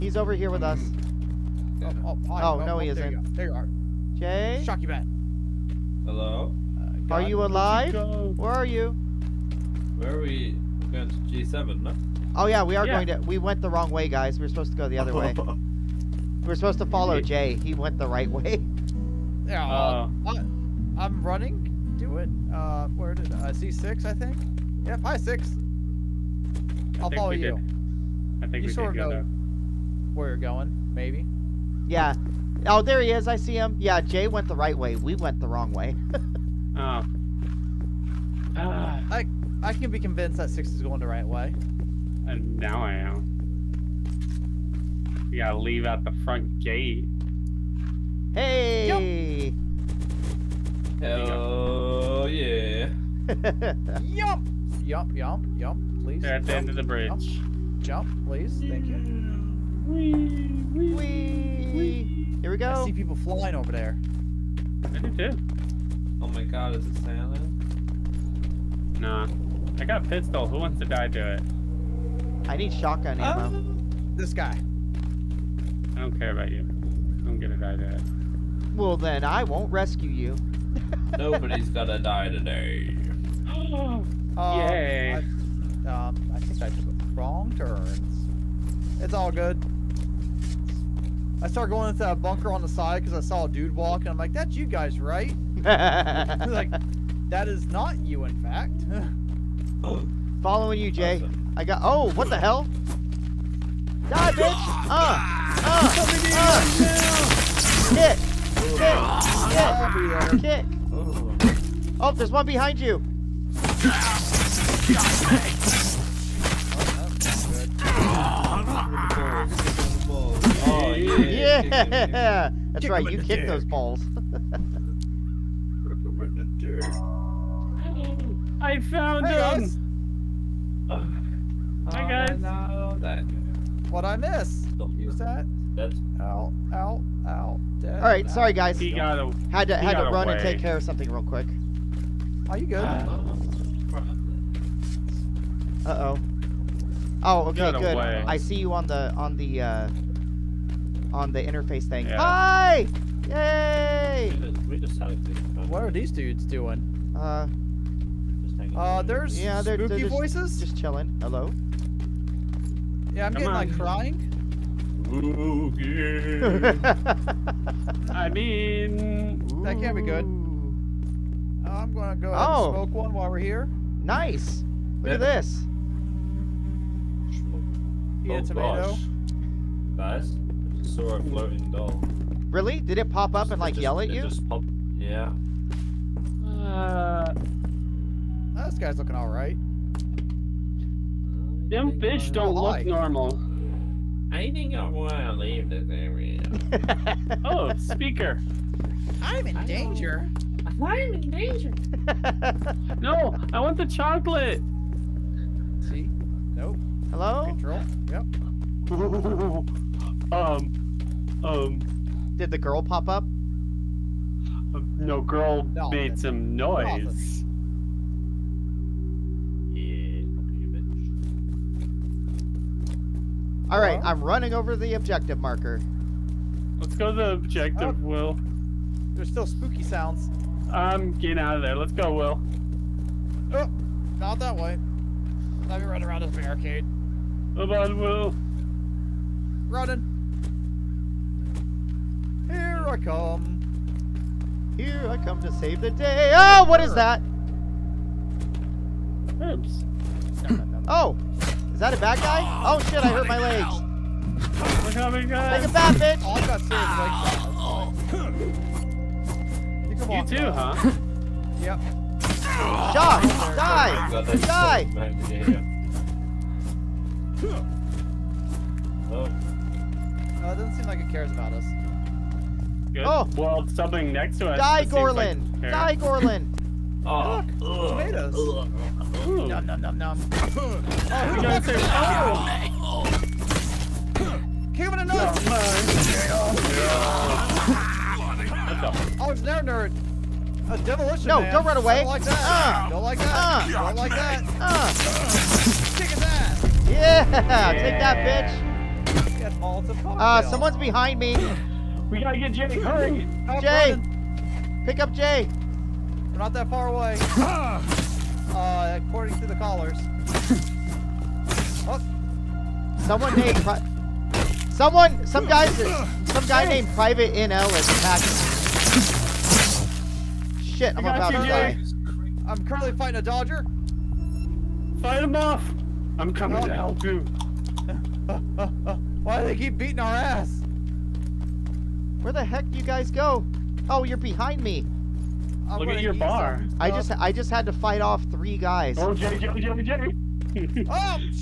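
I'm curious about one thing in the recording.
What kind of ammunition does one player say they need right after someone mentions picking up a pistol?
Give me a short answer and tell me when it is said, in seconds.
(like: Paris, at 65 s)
Shotgun ammo, at 72 s.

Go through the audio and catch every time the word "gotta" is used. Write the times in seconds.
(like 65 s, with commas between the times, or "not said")
45 s, 302 s.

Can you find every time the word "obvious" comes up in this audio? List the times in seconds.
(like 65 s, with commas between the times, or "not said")
not said.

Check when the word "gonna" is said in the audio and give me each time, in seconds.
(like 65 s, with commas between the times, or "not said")
77 s, 81 s, 171 s.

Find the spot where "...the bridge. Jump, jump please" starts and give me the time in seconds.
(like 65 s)
56 s.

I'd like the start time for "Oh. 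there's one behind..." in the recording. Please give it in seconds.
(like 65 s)
112 s.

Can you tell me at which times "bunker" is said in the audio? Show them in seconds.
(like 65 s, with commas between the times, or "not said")
92 s.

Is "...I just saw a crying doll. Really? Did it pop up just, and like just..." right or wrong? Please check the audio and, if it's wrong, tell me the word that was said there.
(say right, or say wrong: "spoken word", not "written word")
wrong: "floating", not "crying".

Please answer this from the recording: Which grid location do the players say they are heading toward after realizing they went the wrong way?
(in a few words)
G7.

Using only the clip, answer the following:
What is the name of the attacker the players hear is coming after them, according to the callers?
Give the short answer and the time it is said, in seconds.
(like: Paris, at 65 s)
Private NL, at 316 s.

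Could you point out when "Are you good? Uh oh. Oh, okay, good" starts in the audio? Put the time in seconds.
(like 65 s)
142 s.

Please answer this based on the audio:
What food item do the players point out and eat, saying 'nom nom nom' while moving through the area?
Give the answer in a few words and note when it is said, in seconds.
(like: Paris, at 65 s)
Tomatoes, at 277 s.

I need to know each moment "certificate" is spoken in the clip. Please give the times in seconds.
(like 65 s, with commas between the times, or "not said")
not said.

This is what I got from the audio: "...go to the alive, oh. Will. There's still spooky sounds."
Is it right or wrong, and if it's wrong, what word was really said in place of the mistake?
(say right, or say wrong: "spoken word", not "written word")
wrong: "objective", not "alive".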